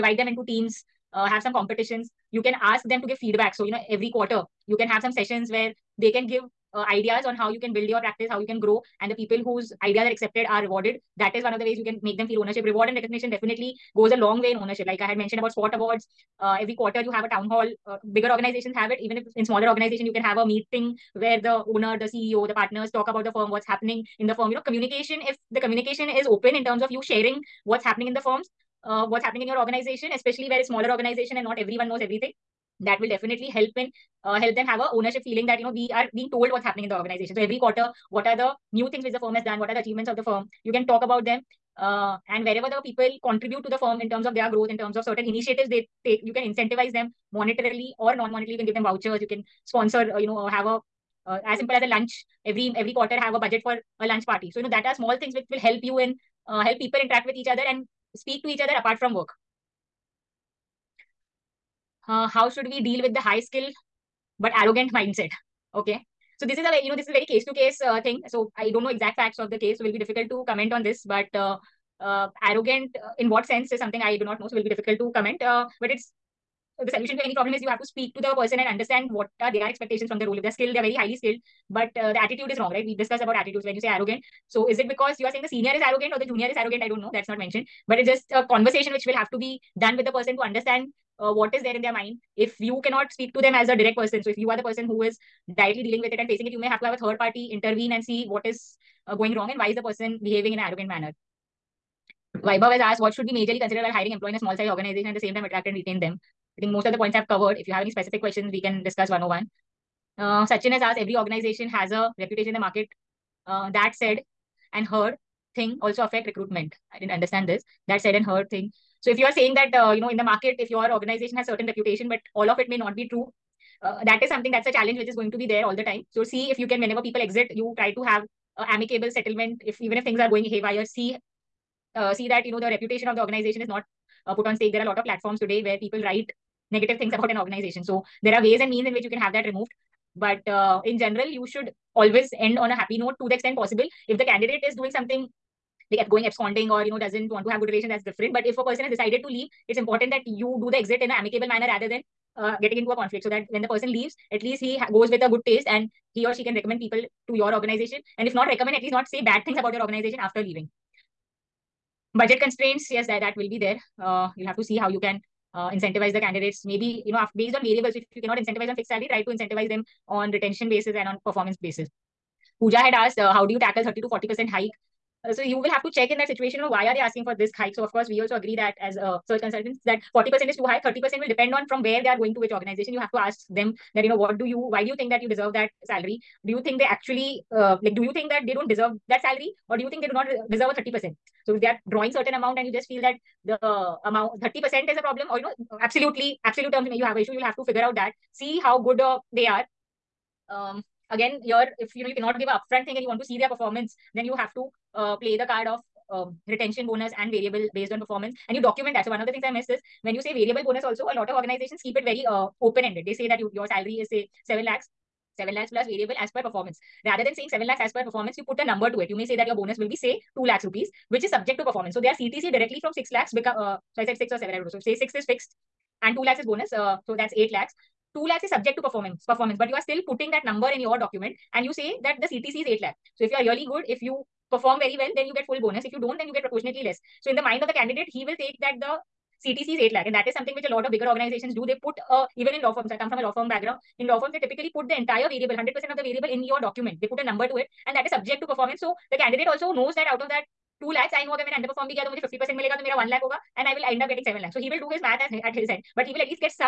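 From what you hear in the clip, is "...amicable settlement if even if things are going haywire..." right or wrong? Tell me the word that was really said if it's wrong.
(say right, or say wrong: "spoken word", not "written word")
right.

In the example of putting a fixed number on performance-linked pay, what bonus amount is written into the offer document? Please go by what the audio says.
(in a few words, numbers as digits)
2 lakhs rupees.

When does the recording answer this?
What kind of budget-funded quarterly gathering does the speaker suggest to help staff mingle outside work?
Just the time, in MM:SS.
00:54.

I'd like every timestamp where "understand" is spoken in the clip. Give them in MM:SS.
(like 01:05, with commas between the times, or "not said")
01:18, 01:30, 01:57.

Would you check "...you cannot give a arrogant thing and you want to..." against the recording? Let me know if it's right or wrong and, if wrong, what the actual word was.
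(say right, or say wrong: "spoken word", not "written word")
wrong: "upfront", not "arrogant".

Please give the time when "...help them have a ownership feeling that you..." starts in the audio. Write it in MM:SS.
00:34.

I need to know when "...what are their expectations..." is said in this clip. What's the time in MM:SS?
01:19.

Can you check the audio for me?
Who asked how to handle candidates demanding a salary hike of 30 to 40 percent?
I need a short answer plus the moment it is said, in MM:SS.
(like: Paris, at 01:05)
Pooja, at 02:52.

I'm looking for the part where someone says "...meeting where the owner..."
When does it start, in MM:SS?
00:20.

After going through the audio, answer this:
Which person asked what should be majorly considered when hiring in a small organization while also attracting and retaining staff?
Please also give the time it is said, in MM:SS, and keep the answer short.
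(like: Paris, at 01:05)
Vaibhav, at 01:42.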